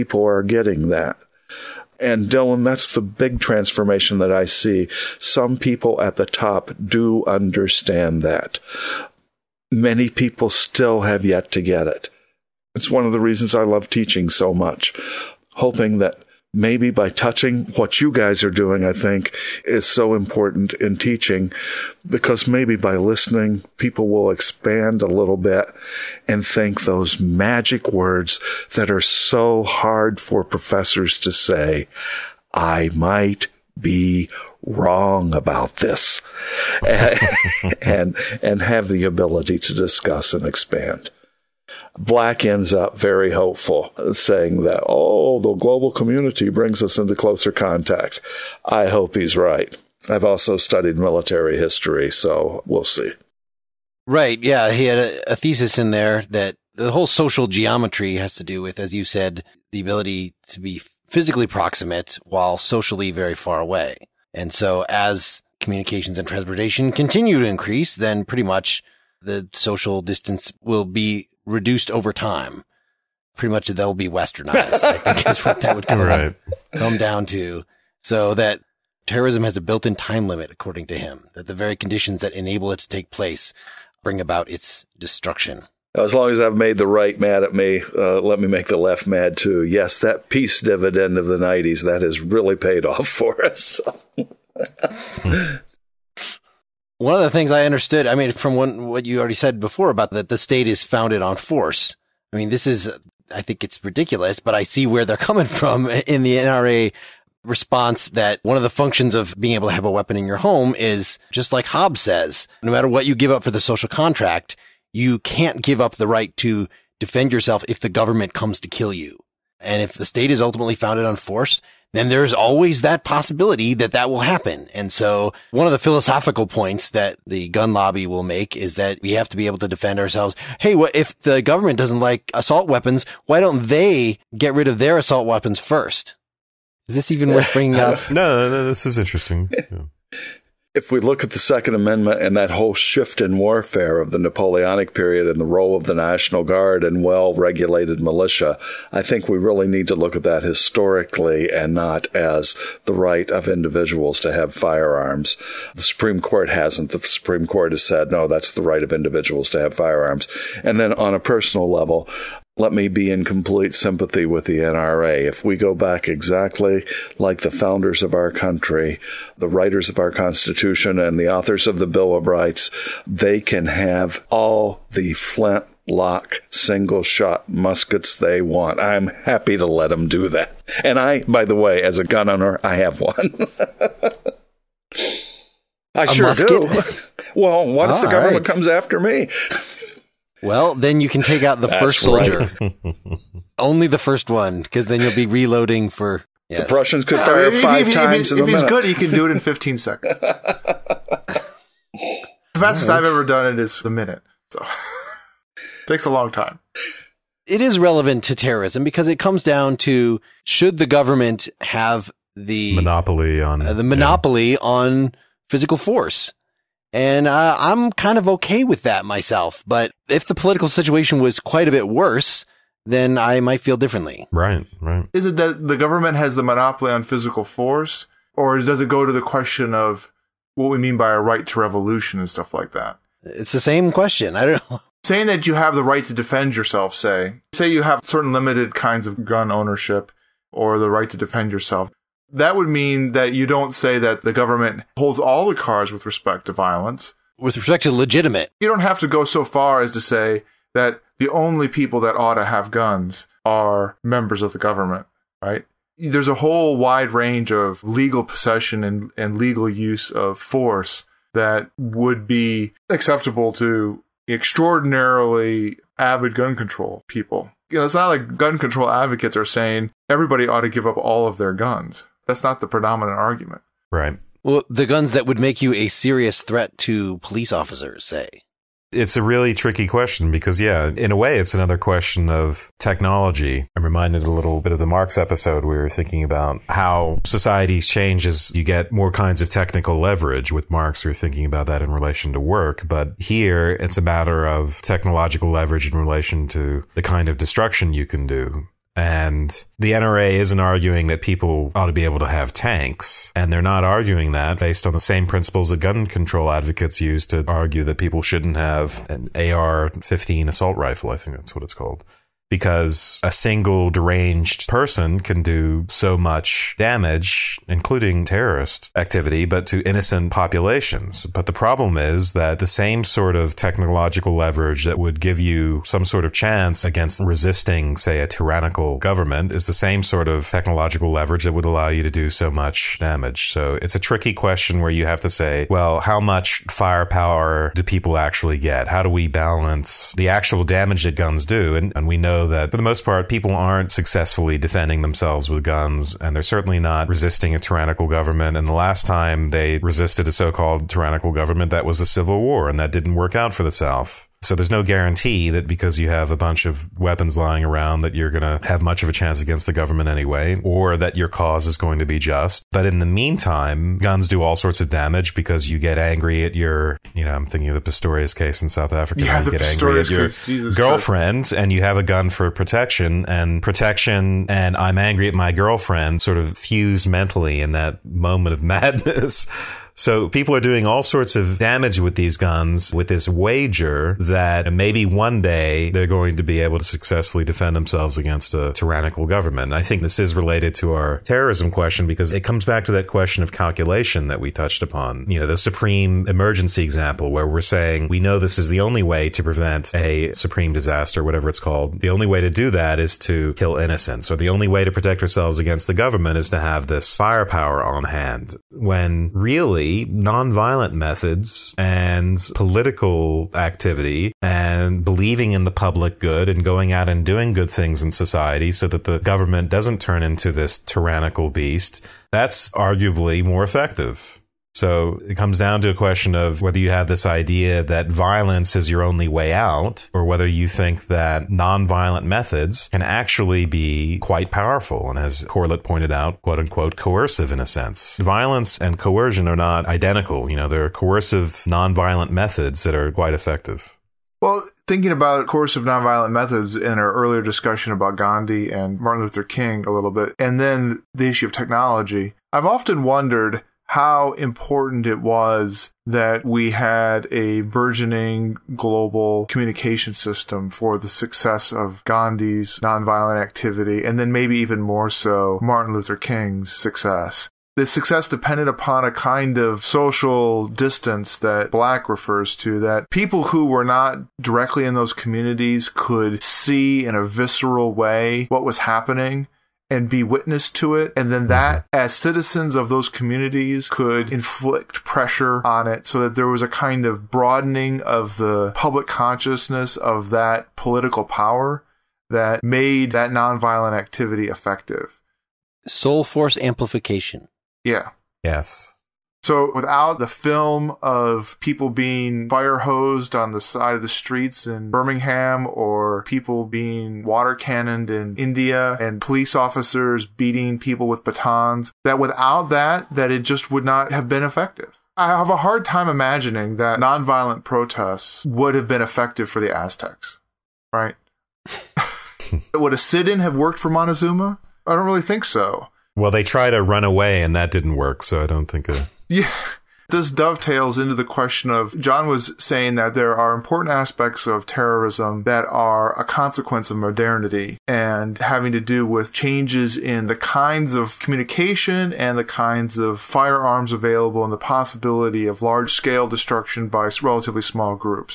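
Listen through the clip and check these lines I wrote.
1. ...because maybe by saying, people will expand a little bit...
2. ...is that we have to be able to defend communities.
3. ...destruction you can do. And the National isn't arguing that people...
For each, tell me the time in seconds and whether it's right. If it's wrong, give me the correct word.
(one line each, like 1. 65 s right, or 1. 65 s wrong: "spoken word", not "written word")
1. 22 s wrong: "listening", not "saying"
2. 128 s wrong: "ourselves", not "communities"
3. 297 s wrong: "NRA", not "National".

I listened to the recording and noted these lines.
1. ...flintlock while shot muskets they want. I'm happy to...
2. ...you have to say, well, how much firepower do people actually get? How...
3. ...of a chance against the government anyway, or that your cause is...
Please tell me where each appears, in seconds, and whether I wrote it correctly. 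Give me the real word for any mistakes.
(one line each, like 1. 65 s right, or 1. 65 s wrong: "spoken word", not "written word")
1. 175 s wrong: "single", not "while"
2. 334 s right
3. 359 s right.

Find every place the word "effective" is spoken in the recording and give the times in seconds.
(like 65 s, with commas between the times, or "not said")
423 s, 443 s, 494 s, 514 s, 519 s.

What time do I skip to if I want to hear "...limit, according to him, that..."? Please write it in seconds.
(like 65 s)
80 s.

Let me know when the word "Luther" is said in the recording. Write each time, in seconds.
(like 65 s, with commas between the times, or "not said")
449 s, 465 s.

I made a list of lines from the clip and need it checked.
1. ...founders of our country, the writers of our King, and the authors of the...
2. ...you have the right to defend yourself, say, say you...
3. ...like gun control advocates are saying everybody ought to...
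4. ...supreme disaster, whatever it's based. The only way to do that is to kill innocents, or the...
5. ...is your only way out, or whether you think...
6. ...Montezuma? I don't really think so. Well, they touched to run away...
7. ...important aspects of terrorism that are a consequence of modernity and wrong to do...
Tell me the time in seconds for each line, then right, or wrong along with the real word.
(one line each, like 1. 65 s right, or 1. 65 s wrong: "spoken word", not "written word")
1. 167 s wrong: "Constitution", not "King"
2. 235 s right
3. 268 s right
4. 400 s wrong: "called", not "based"
5. 428 s right
6. 523 s wrong: "tried", not "touched"
7. 533 s wrong: "having", not "wrong".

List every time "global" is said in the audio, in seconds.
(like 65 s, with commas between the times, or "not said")
45 s, 458 s.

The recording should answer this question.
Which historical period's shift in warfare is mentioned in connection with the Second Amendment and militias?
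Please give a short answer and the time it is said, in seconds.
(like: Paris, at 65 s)
Napoleonic period, at 144 s.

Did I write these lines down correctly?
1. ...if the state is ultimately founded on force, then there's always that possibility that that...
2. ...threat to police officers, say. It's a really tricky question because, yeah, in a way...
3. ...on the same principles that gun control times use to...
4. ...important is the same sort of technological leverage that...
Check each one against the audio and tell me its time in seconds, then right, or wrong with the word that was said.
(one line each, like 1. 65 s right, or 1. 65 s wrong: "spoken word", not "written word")
1. 119 s right
2. 276 s right
3. 304 s wrong: "advocates", not "times"
4. 328 s wrong: "government", not "important".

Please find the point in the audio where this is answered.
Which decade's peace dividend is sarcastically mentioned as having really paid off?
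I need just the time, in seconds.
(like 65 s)
91 s.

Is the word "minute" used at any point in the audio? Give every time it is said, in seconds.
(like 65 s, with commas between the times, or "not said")
198 s, 203 s.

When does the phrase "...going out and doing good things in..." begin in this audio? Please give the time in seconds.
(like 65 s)
416 s.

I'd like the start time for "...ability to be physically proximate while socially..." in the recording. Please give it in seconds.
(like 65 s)
59 s.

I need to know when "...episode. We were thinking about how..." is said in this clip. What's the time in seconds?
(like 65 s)
285 s.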